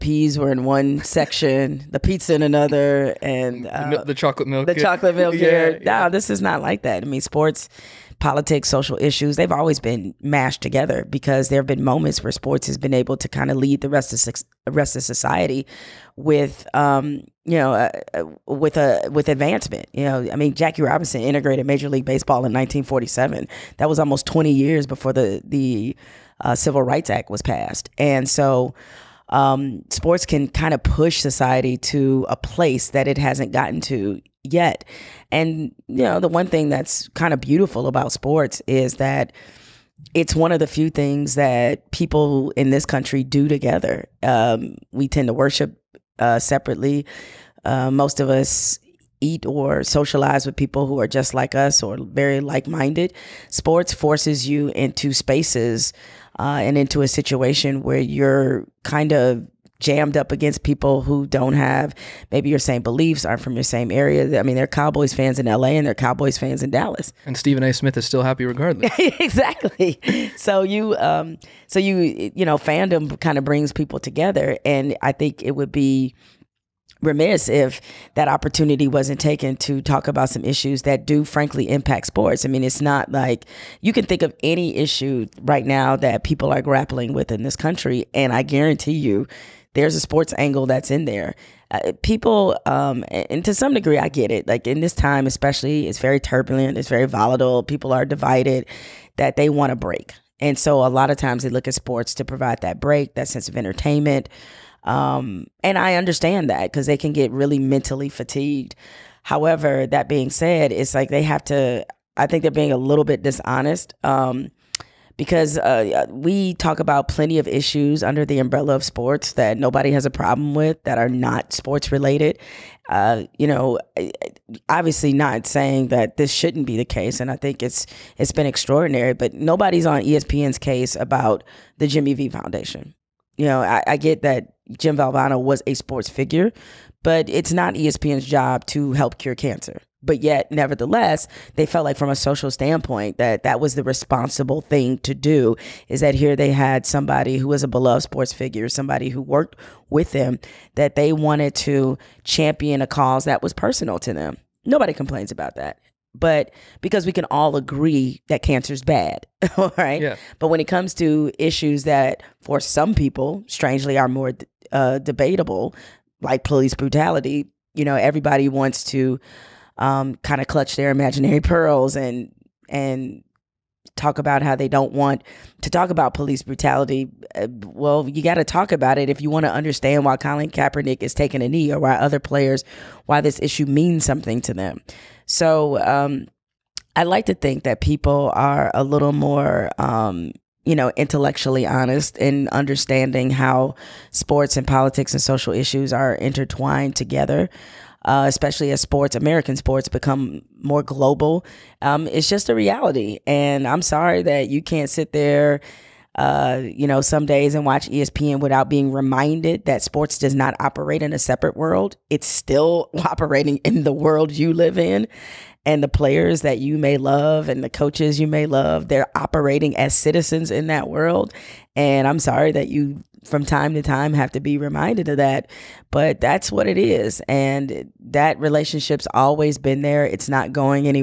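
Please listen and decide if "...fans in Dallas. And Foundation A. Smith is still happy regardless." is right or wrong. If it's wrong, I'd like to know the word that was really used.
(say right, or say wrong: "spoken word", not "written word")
wrong: "Stephen", not "Foundation".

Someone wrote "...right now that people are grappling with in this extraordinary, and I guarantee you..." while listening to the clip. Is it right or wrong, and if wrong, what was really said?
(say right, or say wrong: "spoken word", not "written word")
wrong: "country", not "extraordinary".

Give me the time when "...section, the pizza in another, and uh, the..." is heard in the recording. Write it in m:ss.
0:01.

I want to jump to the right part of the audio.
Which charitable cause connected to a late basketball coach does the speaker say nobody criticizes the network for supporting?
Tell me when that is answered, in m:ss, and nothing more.
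2:11.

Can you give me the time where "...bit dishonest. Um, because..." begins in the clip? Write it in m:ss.
1:53.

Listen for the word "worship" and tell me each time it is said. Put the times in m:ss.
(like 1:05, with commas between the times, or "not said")
0:45.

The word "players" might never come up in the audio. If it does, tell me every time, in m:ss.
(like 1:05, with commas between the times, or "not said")
3:02, 3:35.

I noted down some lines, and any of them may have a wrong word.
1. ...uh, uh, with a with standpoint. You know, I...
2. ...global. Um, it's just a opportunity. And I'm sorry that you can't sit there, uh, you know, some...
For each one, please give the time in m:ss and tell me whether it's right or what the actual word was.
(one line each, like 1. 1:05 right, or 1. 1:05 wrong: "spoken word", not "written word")
1. 0:17 wrong: "advancement", not "standpoint"
2. 3:20 wrong: "reality", not "opportunity".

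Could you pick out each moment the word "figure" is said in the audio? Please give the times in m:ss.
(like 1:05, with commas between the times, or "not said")
2:16, 2:28.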